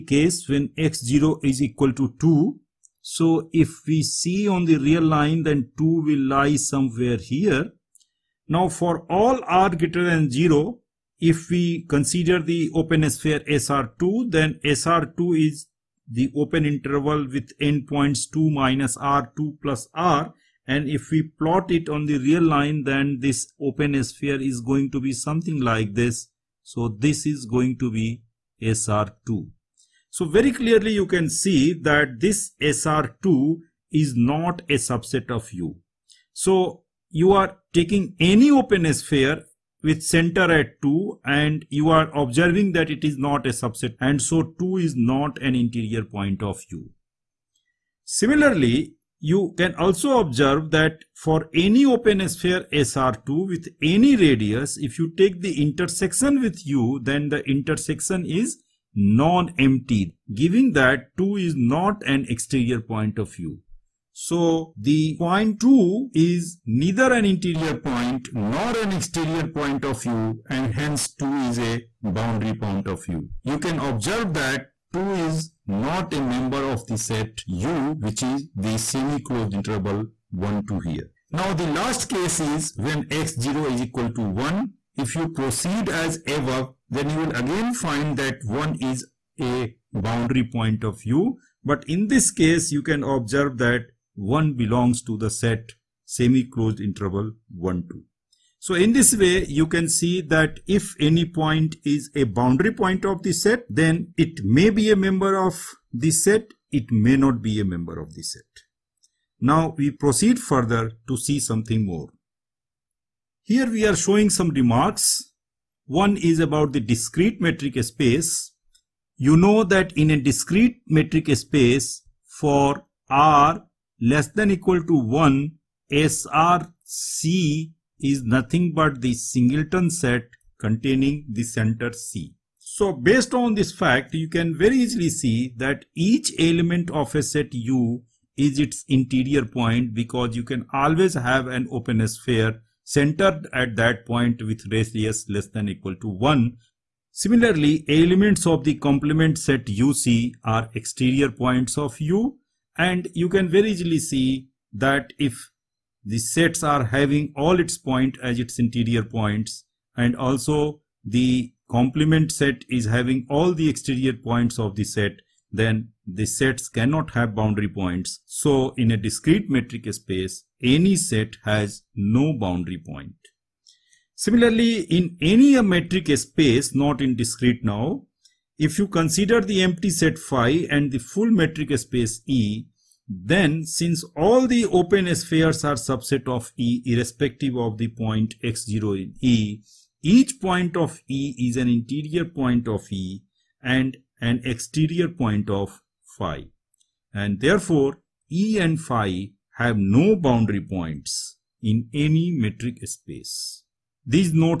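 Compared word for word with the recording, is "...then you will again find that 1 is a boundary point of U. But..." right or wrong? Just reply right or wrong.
right.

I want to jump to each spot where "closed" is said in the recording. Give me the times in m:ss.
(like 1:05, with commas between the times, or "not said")
1:18, 1:36.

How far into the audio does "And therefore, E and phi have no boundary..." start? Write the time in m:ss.
3:17.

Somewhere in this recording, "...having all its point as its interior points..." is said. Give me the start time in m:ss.
2:36.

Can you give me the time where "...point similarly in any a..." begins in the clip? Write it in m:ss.
2:52.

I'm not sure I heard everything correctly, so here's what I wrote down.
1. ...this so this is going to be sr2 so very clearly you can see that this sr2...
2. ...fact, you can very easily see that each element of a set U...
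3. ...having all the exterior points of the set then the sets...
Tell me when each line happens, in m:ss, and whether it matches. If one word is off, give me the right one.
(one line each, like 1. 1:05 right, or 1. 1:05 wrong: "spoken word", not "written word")
1. 0:25 right
2. 2:13 right
3. 2:42 right.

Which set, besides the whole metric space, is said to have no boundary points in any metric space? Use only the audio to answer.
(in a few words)
empty set phi.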